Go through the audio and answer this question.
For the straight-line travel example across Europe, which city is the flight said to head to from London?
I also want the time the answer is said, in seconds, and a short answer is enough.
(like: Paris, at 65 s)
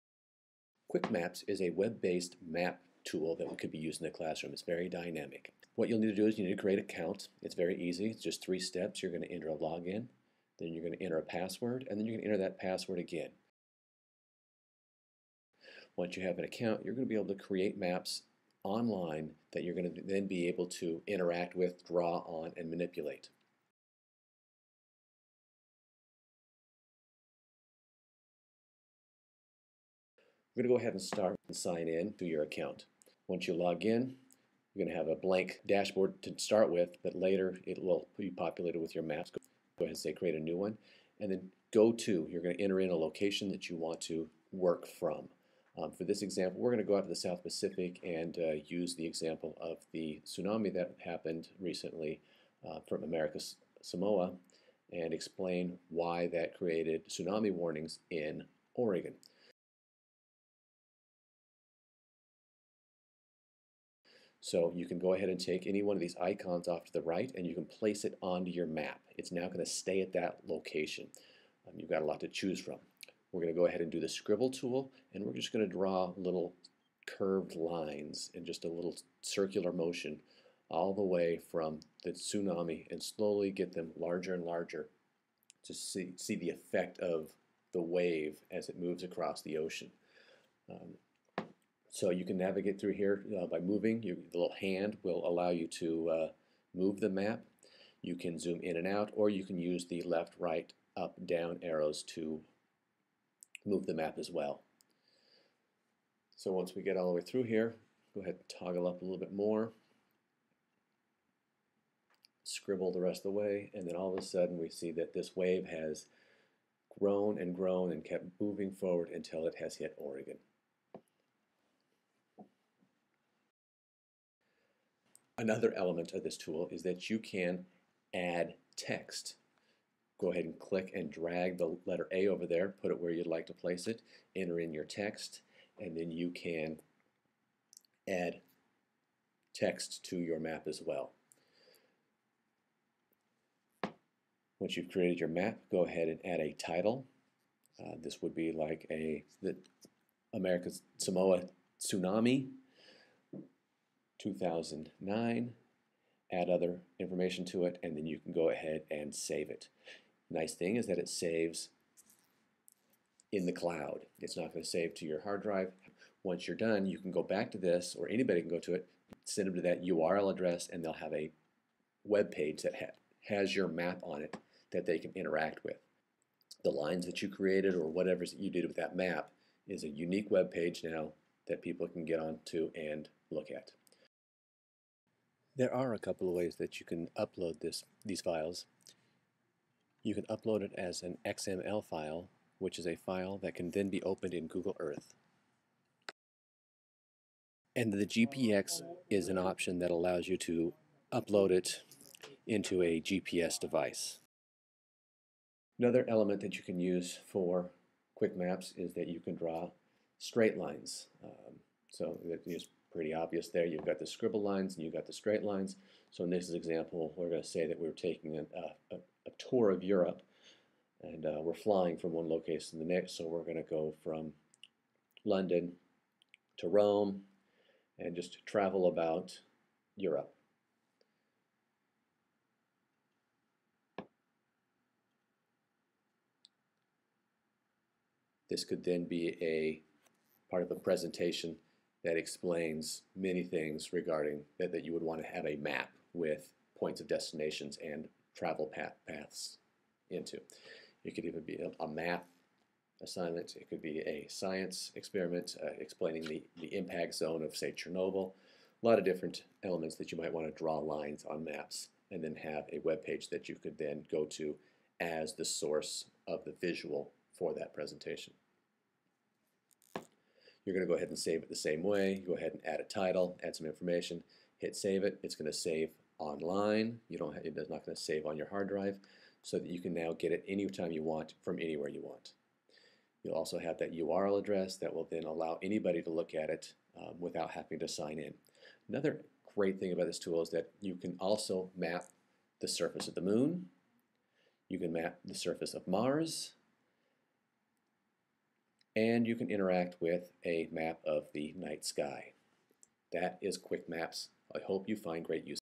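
Rome, at 226 s.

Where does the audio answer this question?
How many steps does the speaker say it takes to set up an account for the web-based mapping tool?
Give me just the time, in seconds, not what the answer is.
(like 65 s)
8 s.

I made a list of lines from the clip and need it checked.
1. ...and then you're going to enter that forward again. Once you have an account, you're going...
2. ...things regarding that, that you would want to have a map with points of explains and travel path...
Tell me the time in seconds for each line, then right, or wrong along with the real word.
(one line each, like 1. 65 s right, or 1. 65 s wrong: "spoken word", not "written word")
1. 11 s wrong: "password", not "forward"
2. 243 s wrong: "destinations", not "explains".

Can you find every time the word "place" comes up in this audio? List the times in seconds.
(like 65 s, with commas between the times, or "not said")
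67 s, 133 s.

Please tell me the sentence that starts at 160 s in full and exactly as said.
Nice thing is that it saves in the cloud.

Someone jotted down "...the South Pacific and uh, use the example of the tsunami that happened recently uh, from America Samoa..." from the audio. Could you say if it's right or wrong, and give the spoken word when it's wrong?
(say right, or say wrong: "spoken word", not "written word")
right.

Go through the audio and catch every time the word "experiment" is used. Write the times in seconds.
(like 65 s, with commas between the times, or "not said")
254 s.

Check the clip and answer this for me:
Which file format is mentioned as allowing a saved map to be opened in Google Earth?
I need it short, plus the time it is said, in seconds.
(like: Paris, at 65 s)
XML, at 191 s.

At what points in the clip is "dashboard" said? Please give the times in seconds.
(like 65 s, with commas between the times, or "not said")
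35 s.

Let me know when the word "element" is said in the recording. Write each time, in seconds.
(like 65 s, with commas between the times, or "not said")
125 s, 206 s, 259 s.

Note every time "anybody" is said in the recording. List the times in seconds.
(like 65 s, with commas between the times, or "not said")
168 s, 285 s.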